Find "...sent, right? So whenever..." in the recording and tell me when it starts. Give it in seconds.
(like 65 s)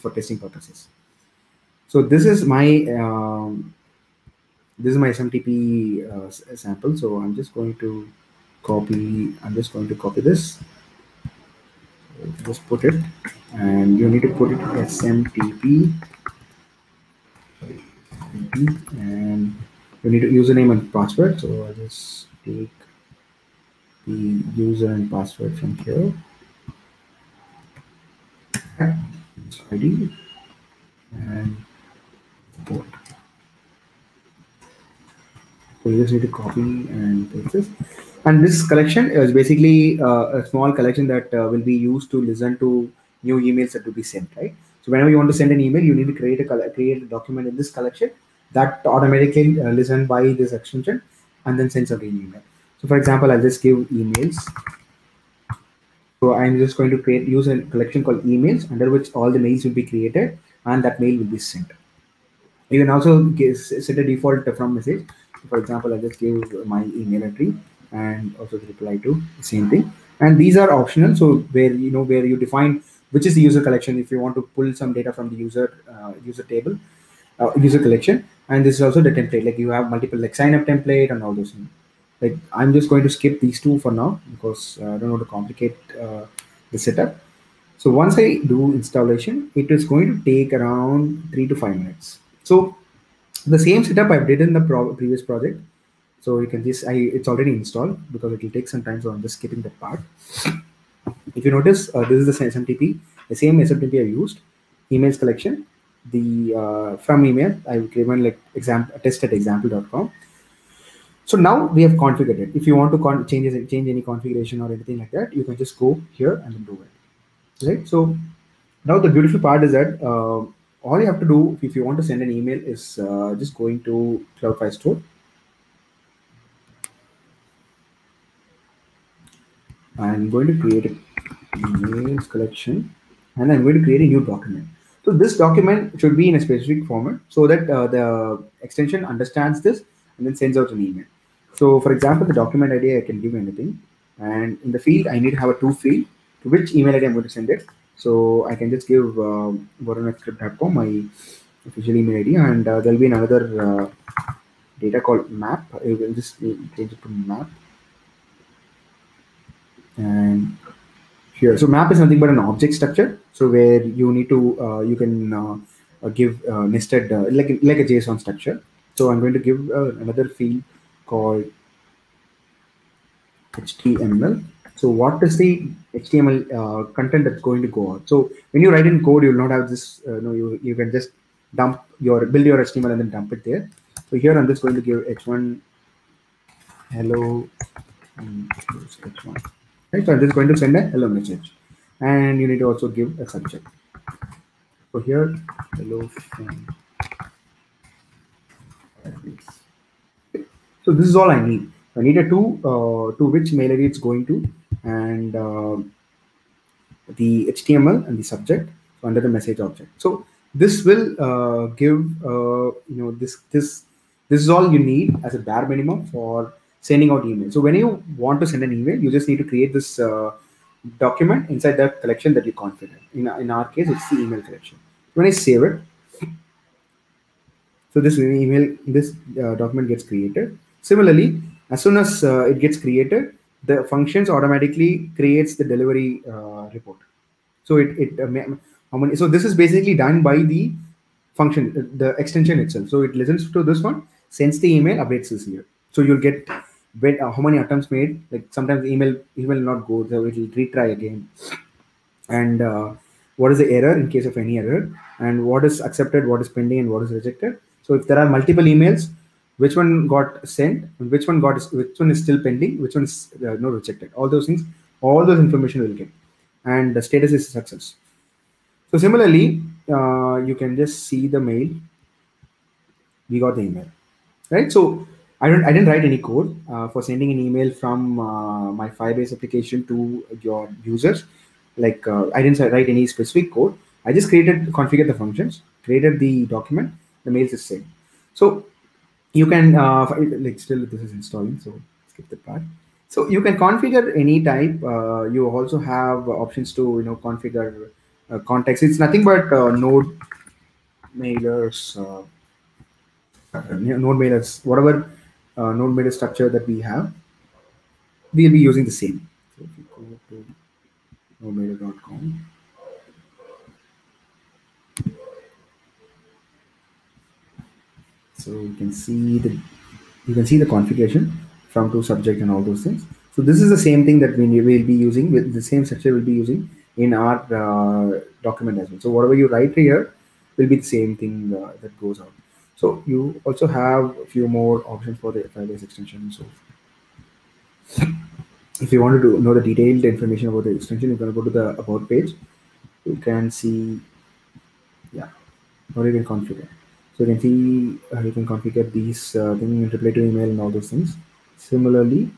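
44 s.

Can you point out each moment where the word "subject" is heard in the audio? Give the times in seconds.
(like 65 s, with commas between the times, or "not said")
193 s, 208 s, 322 s.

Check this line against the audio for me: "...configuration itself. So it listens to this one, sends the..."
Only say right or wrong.
wrong.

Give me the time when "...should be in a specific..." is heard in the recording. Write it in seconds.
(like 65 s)
135 s.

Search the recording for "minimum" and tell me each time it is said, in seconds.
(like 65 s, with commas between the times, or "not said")
215 s.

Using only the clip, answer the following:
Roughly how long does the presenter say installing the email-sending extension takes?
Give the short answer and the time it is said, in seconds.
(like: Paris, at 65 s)
3 to 5 minutes, at 91 s.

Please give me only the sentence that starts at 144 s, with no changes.
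And in the field, I need to have a two field to which email ID I'm going to send it.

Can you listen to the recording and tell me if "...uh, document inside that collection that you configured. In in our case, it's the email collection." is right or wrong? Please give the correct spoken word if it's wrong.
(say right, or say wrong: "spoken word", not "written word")
right.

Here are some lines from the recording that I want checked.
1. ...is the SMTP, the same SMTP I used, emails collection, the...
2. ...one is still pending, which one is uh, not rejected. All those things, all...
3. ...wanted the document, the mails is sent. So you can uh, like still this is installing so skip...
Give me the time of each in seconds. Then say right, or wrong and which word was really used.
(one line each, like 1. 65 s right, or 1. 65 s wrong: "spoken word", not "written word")
1. 102 s right
2. 261 s right
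3. 285 s wrong: "created", not "wanted".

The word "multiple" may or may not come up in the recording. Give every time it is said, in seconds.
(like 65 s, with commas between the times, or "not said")
79 s, 258 s.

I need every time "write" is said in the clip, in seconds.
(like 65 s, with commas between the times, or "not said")
178 s, 275 s, 282 s, 329 s.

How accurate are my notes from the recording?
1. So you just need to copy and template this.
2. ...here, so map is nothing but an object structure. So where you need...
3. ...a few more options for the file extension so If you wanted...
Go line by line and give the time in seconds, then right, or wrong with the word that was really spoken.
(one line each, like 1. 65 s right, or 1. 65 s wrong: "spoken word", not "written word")
1. 35 s wrong: "paste", not "template"
2. 161 s right
3. 334 s right.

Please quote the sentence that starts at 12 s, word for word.
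Just put it and you need to put it SMTP and you need to username and password.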